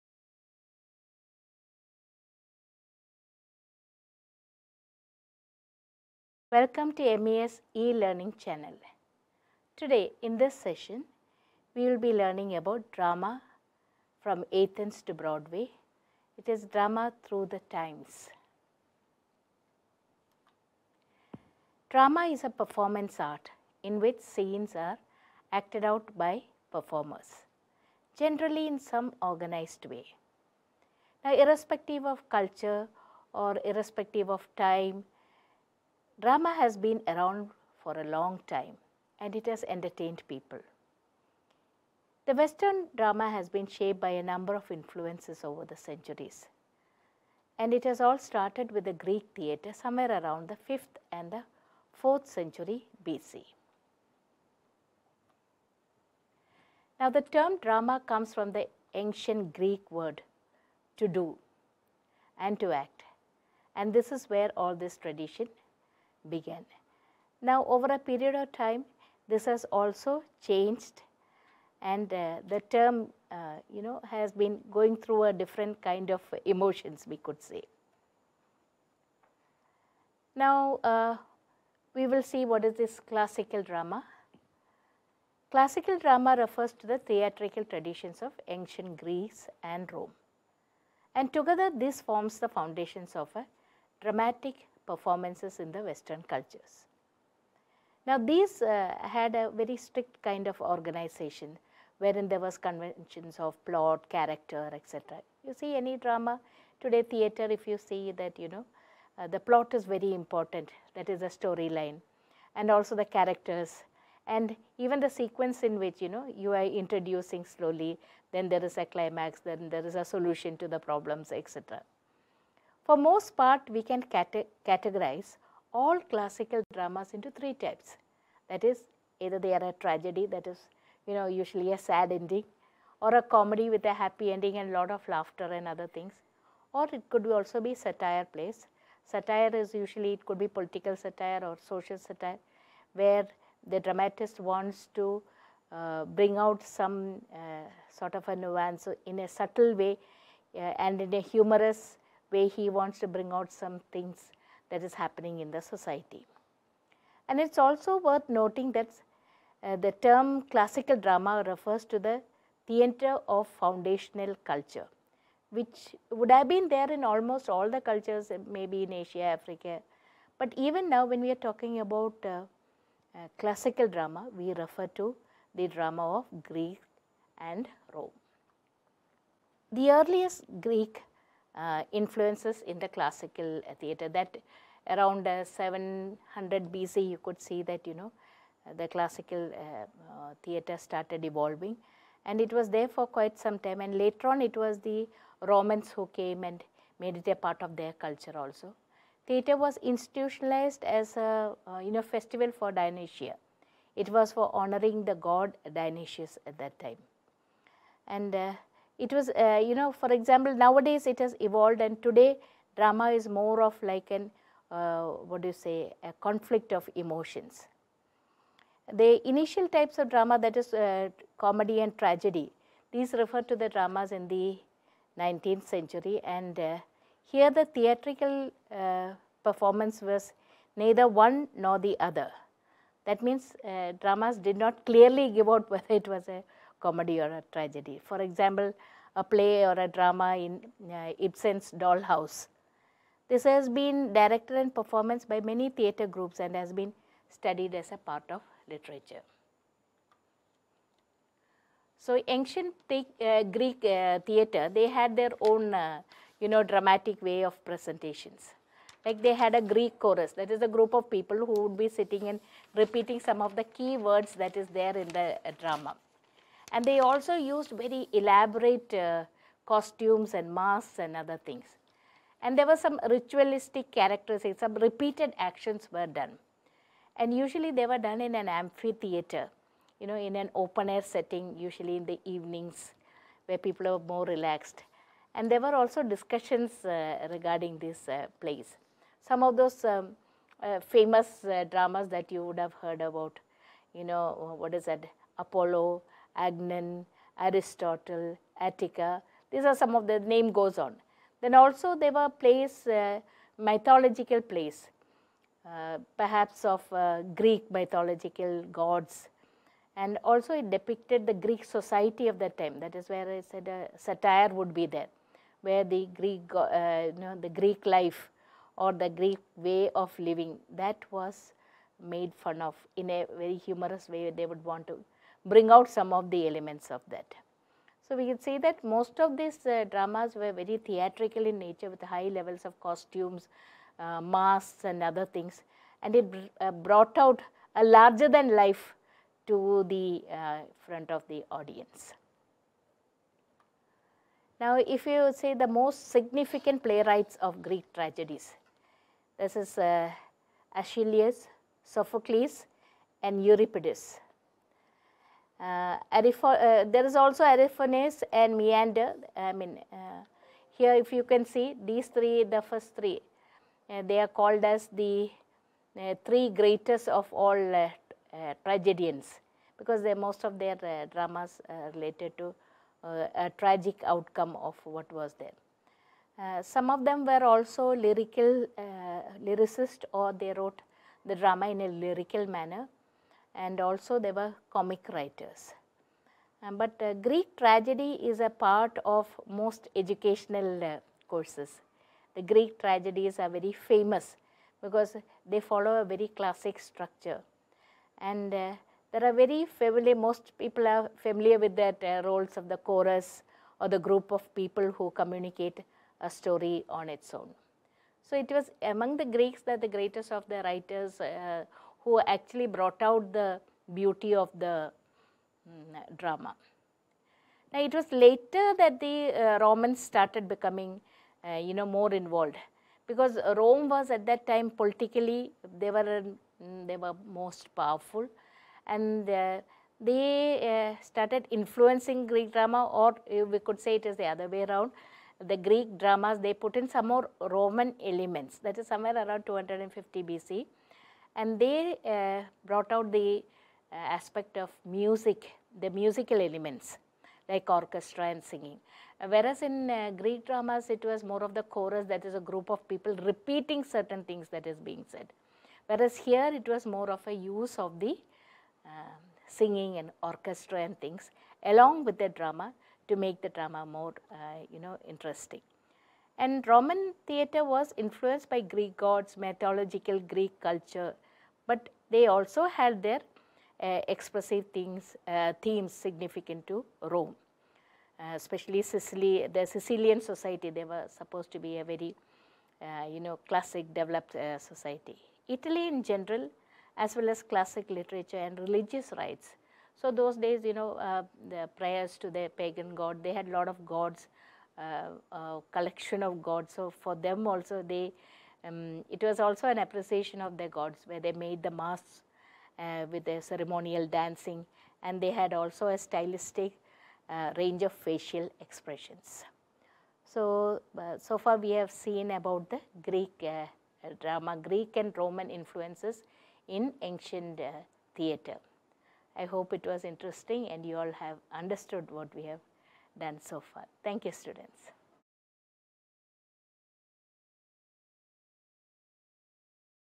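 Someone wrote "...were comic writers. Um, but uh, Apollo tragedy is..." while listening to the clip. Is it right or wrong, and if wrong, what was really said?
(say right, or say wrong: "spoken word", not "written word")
wrong: "Greek", not "Apollo".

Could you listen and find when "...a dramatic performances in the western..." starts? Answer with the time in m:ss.
1:33.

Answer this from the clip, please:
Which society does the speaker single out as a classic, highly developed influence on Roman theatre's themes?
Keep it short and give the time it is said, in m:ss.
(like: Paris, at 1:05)
Sicilian society, at 7:59.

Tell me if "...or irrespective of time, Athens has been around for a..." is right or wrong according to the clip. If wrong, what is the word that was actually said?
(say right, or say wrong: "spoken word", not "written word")
wrong: "Drama", not "Athens".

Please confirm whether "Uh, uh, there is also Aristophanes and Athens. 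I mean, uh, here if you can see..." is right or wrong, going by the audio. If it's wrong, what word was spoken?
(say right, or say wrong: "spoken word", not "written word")
wrong: "Menander", not "Athens".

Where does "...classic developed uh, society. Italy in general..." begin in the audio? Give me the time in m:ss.
8:03.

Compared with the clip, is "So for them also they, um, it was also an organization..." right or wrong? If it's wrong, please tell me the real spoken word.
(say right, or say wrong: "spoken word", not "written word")
wrong: "appreciation", not "organization".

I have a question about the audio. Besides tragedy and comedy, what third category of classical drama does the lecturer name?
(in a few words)
Satire plays.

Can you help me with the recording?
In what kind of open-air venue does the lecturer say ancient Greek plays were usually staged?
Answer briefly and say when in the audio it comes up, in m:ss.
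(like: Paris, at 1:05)
Amphitheater, at 4:38.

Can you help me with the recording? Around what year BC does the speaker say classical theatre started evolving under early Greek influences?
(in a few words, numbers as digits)
700 BC.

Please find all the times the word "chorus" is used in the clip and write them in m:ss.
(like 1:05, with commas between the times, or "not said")
4:19, 6:42, 7:31.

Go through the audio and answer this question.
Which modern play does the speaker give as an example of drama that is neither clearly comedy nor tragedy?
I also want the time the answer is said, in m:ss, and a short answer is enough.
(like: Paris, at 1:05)
Ibsen's Dollhouse, at 4:01.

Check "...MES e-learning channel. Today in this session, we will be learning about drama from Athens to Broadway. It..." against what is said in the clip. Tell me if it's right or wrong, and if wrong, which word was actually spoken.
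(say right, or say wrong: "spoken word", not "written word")
right.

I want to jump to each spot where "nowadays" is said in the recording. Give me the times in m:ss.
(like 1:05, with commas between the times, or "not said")
3:30.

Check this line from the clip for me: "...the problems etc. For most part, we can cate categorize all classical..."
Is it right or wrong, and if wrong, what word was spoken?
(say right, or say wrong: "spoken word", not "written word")
right.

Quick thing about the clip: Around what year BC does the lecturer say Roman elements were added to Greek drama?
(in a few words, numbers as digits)
250 BC.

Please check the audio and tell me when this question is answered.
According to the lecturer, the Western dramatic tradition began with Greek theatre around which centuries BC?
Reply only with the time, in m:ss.
0:50.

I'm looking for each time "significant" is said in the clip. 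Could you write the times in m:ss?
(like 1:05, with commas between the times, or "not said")
5:46, 7:55.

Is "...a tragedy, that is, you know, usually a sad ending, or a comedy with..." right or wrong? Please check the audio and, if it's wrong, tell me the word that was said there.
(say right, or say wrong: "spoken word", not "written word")
right.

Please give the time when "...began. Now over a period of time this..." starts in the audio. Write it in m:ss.
1:06.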